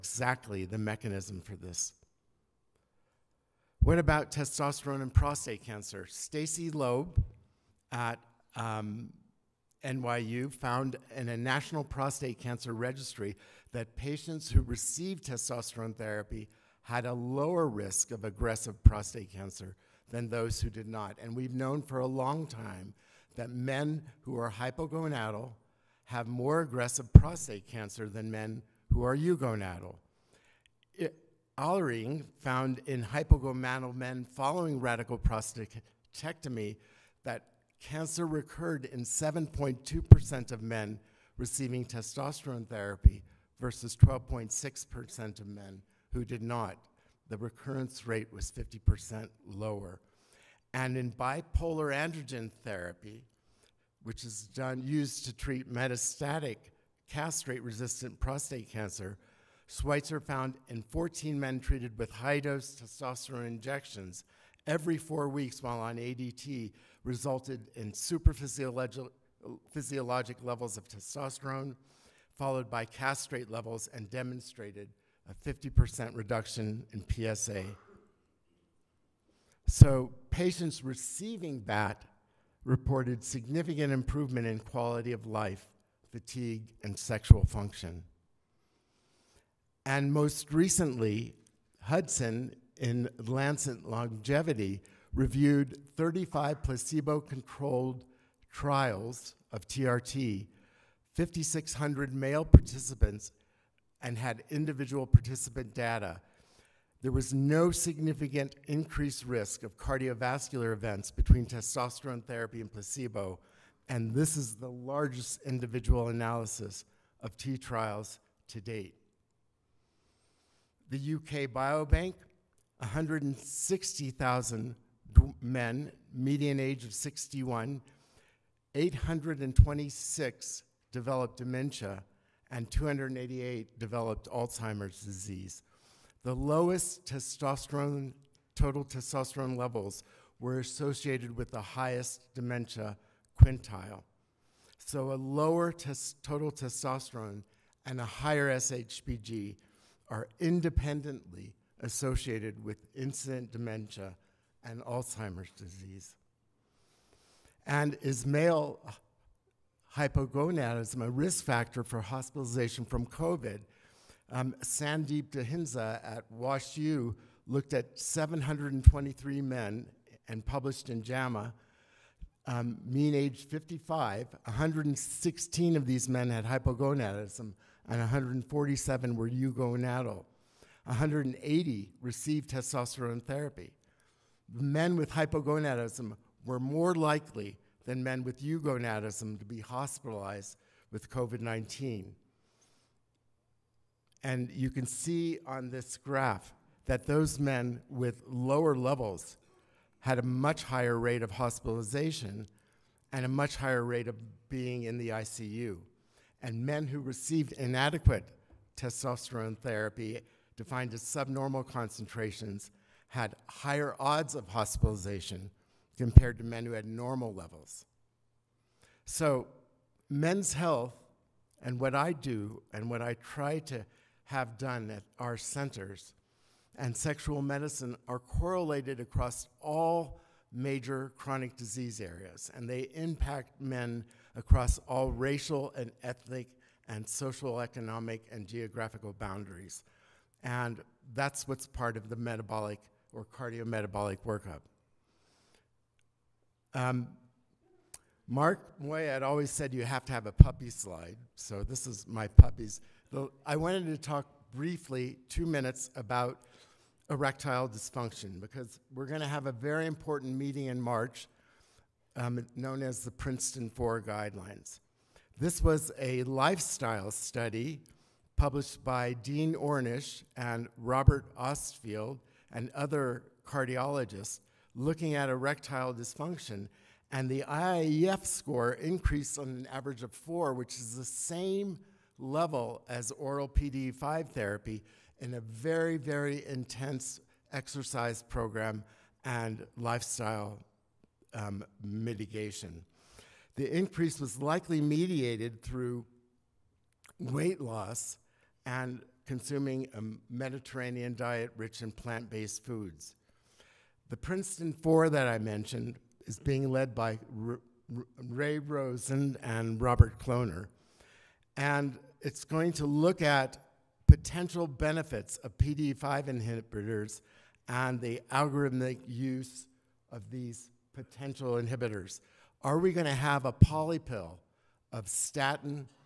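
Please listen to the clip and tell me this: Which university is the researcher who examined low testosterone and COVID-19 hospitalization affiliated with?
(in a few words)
WashU.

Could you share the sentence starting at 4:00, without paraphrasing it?
And that's what's part of the metabolic or cardiometabolic workup.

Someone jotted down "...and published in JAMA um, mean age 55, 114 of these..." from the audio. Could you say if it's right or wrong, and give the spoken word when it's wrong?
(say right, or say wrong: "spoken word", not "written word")
wrong: "116", not "114".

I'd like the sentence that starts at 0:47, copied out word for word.
The recurrence rate was 50% lower.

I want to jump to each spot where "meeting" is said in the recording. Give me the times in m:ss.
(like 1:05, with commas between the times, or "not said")
4:20.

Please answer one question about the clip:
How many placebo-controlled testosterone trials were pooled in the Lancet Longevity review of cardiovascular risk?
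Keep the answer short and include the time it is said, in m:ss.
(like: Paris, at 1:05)
35, at 1:35.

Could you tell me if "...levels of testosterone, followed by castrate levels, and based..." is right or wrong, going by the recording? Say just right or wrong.
wrong.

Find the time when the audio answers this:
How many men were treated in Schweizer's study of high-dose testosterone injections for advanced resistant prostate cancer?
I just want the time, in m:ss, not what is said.
1:00.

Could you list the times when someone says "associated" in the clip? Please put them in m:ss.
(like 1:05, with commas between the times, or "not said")
2:20, 2:31.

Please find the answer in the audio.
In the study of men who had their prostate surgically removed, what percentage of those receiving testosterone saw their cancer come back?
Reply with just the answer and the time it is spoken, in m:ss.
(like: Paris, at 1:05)
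7.2%, at 0:39.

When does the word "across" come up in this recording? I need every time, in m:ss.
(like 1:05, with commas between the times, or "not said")
3:49, 3:54.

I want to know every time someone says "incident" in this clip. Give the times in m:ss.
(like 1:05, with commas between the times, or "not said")
2:32.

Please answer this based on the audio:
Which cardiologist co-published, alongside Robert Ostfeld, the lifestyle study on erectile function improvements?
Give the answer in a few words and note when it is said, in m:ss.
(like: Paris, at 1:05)
Dean Ornish, at 4:29.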